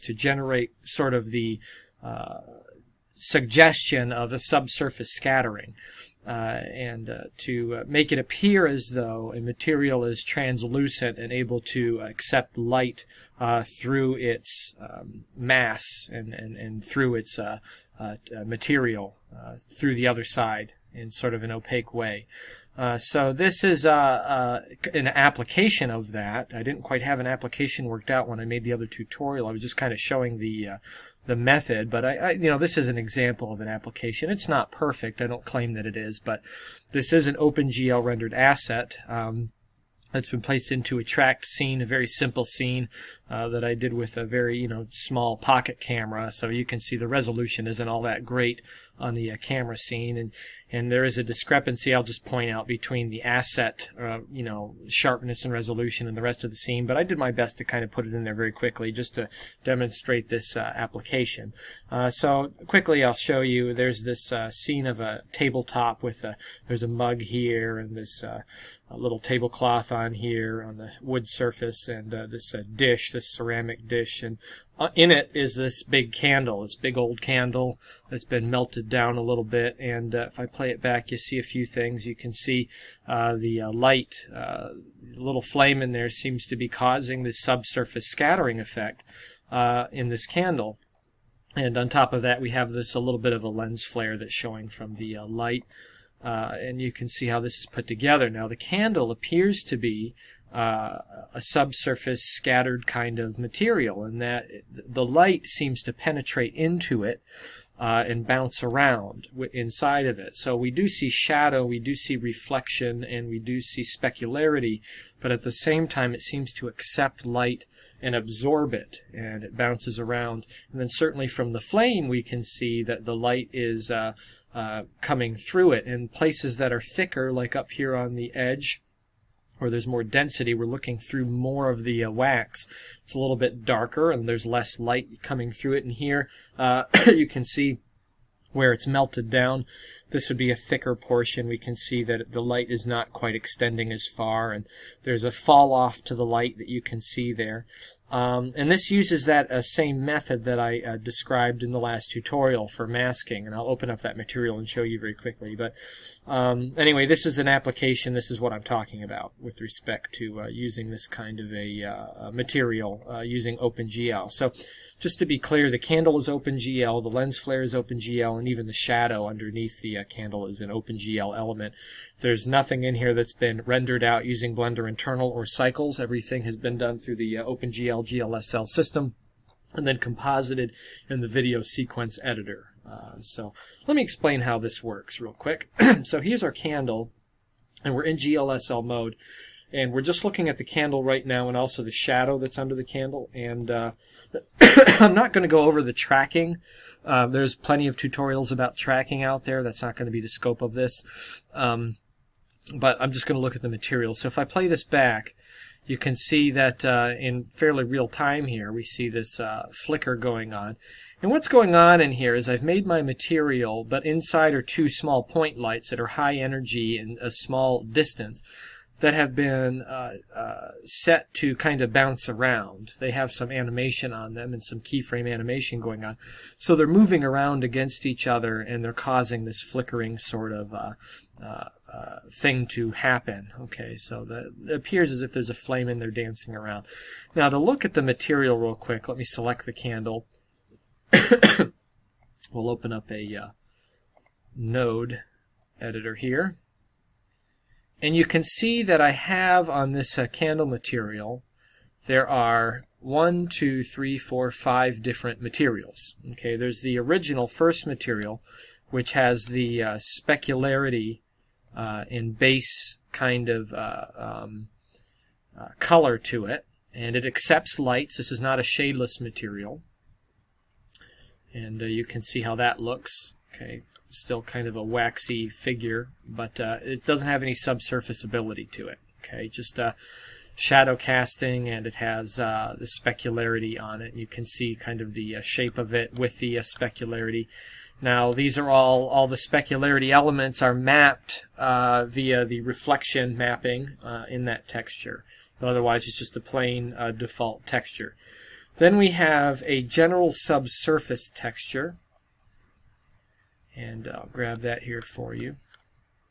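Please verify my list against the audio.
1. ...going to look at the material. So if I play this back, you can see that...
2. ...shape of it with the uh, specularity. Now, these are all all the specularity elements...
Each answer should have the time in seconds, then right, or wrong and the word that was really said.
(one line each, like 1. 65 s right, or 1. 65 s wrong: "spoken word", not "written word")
1. 203 s right
2. 285 s right.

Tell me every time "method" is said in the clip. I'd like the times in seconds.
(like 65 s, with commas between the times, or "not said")
31 s, 150 s.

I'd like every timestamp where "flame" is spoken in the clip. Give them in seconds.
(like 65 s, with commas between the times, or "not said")
85 s, 121 s, 235 s.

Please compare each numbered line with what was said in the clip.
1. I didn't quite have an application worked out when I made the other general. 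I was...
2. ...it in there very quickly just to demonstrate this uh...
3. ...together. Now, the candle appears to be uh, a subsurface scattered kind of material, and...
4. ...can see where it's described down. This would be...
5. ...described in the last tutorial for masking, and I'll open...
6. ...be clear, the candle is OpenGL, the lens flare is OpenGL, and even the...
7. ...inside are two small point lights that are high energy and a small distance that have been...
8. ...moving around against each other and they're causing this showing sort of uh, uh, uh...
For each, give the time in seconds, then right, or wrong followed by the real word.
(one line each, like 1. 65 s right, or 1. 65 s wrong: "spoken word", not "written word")
1. 26 s wrong: "tutorial", not "general"
2. 58 s right
3. 97 s right
4. 137 s wrong: "melted", not "described"
5. 150 s right
6. 165 s right
7. 214 s right
8. 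226 s wrong: "flickering", not "showing".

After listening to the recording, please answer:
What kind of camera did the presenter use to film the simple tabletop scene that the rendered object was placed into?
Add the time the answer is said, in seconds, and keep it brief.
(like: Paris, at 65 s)
Small pocket camera, at 44 s.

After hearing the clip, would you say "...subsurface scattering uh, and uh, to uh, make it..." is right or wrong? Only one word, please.
right.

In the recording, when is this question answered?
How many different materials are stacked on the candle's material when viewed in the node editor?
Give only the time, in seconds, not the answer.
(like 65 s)
254 s.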